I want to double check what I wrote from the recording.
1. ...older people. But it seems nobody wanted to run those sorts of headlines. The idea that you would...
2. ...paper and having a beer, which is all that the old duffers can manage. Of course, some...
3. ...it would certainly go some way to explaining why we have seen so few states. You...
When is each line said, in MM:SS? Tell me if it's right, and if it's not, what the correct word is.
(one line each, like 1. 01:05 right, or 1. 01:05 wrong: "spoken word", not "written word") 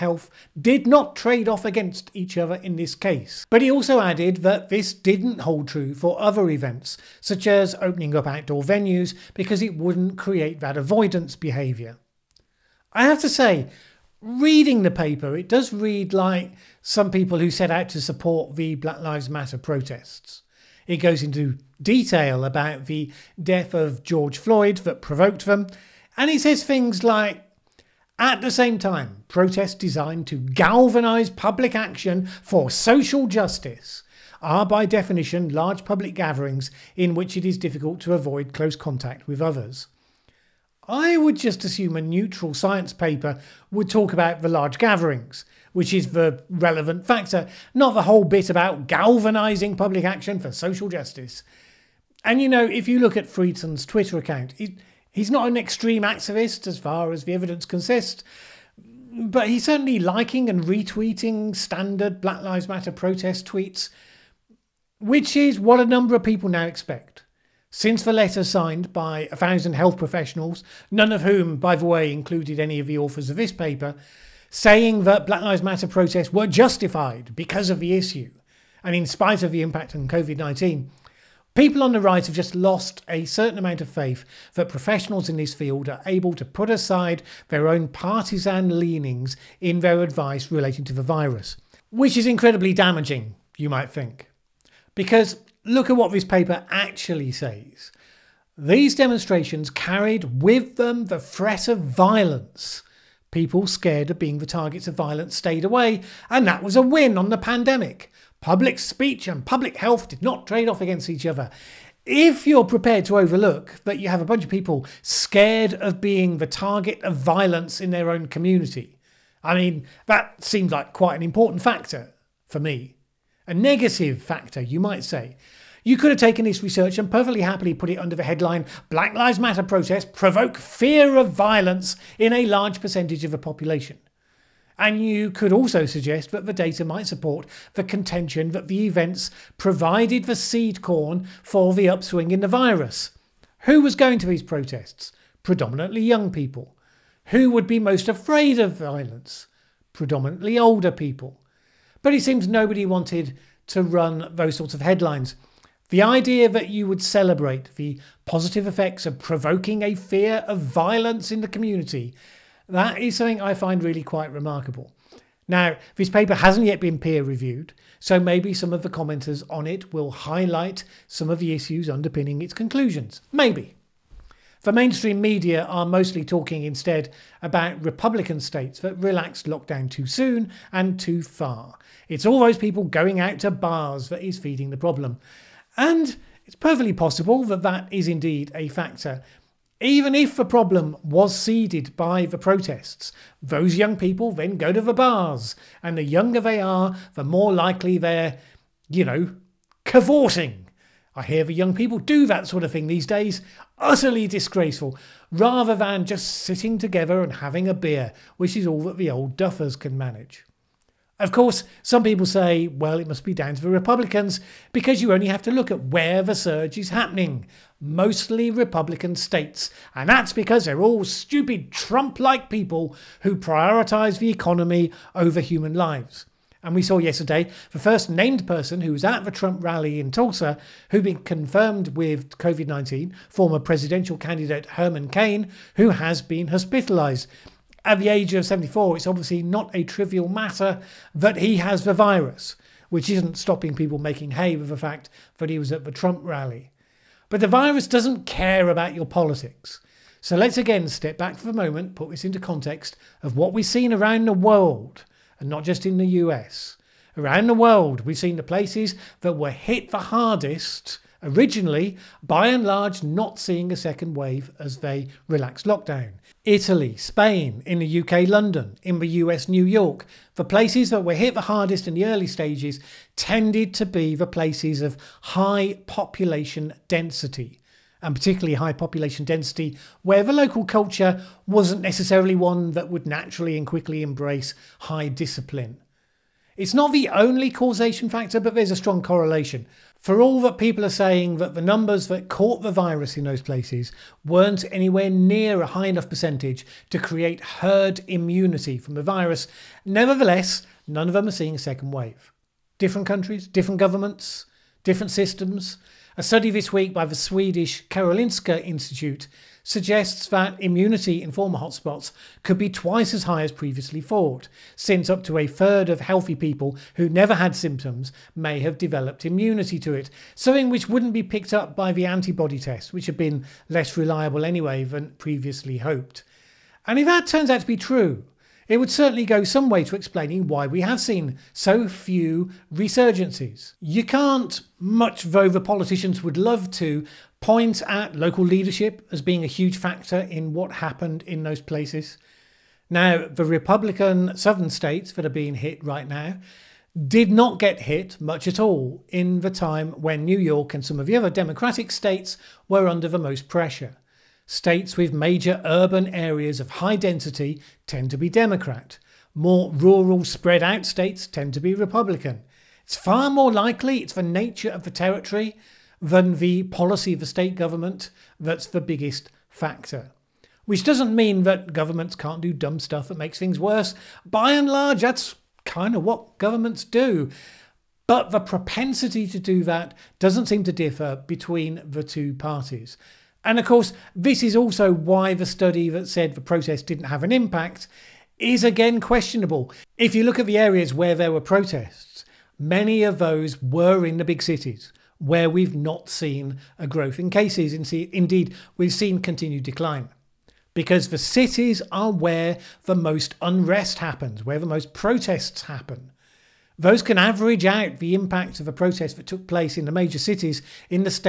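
1. 02:30 right
2. 03:26 wrong: "together", not "paper"
3. 05:28 wrong: "resurgencies", not "states".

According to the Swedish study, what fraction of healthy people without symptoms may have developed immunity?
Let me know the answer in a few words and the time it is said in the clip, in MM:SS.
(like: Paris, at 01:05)
a third, at 05:15.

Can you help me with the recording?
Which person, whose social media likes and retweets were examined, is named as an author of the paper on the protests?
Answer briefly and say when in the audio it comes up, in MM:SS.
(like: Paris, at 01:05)
Friedson, at 00:53.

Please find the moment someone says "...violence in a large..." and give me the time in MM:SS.
02:11.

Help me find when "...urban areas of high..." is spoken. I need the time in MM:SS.
05:55.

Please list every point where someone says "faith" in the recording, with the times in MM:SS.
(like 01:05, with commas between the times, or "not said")
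01:23.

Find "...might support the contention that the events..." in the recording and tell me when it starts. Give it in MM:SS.
02:16.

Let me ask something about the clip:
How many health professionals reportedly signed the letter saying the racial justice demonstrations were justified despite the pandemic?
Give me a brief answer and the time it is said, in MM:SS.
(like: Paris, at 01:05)
1000, at 01:09.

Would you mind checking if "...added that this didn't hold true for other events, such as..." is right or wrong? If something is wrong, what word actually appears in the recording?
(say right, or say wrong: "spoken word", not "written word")
right.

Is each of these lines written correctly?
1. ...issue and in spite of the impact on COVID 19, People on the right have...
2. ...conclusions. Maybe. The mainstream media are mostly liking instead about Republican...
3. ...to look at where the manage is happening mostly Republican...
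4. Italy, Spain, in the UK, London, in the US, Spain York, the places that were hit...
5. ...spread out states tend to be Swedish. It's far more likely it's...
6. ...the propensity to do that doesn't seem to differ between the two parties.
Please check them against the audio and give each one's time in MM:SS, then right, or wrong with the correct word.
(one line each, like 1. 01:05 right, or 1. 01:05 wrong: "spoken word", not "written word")
1. 01:17 right
2. 02:52 wrong: "talking", not "liking"
3. 03:35 wrong: "surge", not "manage"
4. 04:26 wrong: "New", not "Spain"
5. 06:00 wrong: "Republican", not "Swedish"
6. 06:18 right.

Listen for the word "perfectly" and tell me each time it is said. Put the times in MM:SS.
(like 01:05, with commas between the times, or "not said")
02:07, 03:06.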